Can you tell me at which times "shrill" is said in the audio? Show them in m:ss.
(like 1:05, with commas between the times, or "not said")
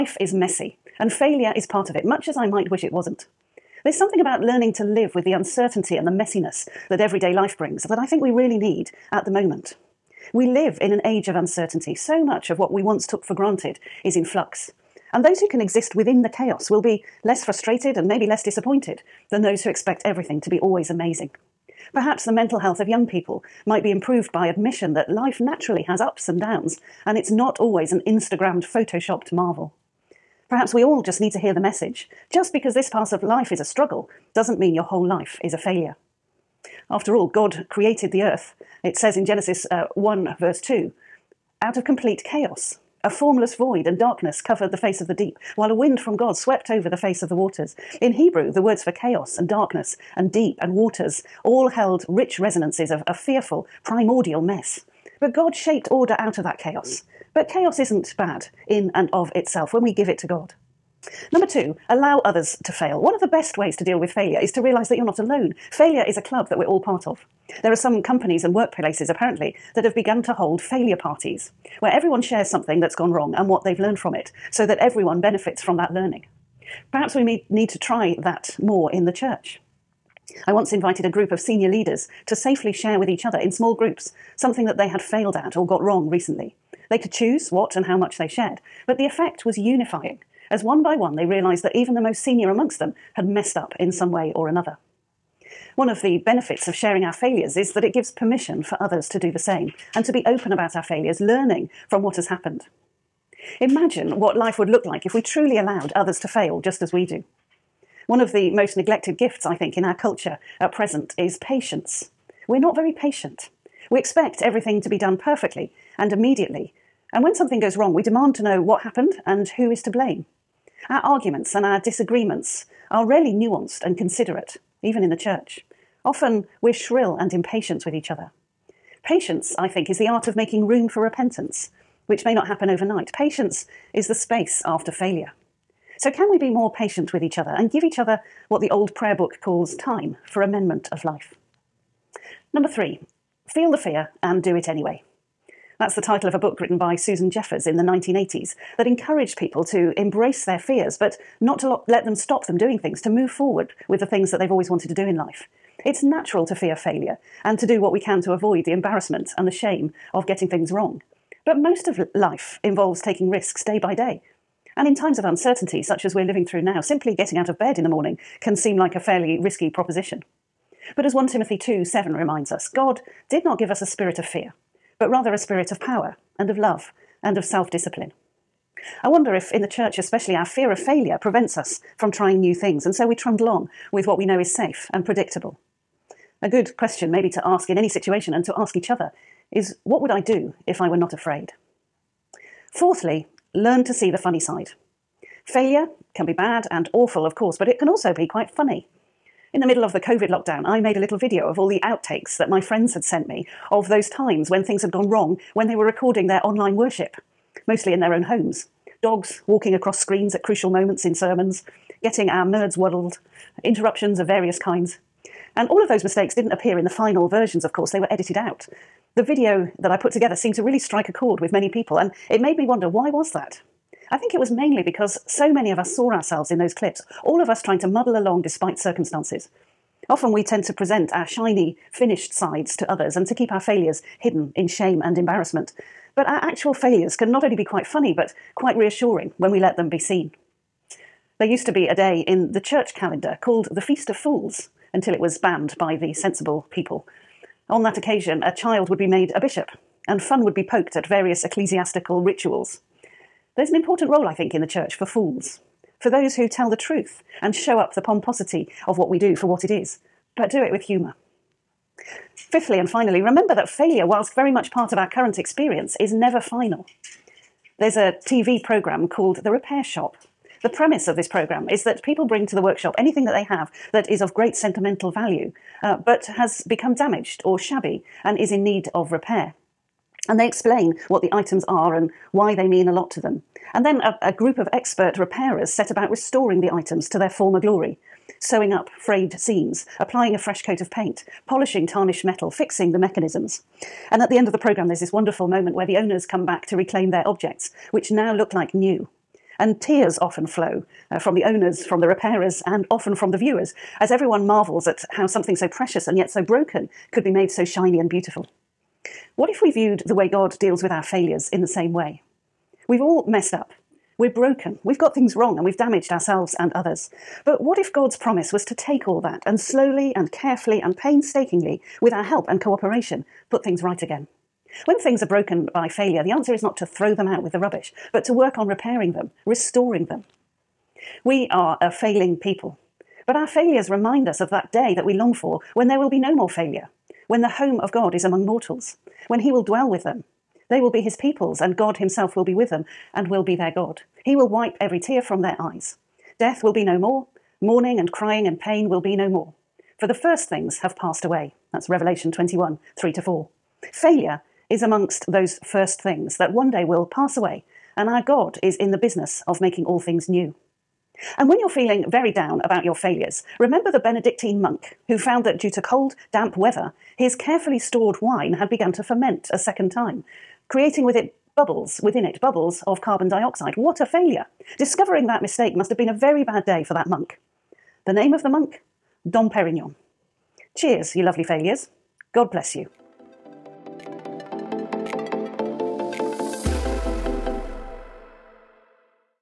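2:06.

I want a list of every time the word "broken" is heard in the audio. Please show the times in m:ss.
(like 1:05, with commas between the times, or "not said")
5:06, 5:14, 5:25.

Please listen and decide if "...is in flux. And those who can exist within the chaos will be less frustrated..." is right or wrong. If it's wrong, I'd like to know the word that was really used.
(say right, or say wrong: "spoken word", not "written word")
right.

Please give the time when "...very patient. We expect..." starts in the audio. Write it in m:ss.
1:52.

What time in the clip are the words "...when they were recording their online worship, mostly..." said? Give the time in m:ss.
3:25.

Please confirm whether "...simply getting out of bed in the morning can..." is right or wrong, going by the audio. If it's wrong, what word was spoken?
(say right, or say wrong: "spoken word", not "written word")
right.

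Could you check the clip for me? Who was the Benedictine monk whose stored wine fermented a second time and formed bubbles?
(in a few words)
Dom Perignon.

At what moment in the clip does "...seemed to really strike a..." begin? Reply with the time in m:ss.
3:40.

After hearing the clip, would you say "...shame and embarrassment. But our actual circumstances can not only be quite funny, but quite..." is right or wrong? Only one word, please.
wrong.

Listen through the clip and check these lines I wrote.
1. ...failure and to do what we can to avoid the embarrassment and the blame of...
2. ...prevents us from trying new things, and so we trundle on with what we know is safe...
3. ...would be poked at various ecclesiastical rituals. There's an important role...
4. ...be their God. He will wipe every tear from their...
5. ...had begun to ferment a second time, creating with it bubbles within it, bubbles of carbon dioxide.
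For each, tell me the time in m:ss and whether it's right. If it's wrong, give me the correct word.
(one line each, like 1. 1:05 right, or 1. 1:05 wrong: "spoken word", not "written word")
1. 2:36 wrong: "shame", not "blame"
2. 3:01 right
3. 4:10 right
4. 5:43 right
5. 6:08 right.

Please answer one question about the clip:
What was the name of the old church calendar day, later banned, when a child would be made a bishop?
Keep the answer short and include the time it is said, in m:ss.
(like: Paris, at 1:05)
Feast of Fools, at 4:03.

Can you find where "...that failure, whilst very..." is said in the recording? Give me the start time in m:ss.
4:23.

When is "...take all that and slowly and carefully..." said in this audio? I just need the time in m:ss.
5:18.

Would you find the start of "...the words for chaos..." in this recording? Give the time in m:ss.
0:48.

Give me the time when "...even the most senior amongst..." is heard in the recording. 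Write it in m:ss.
1:31.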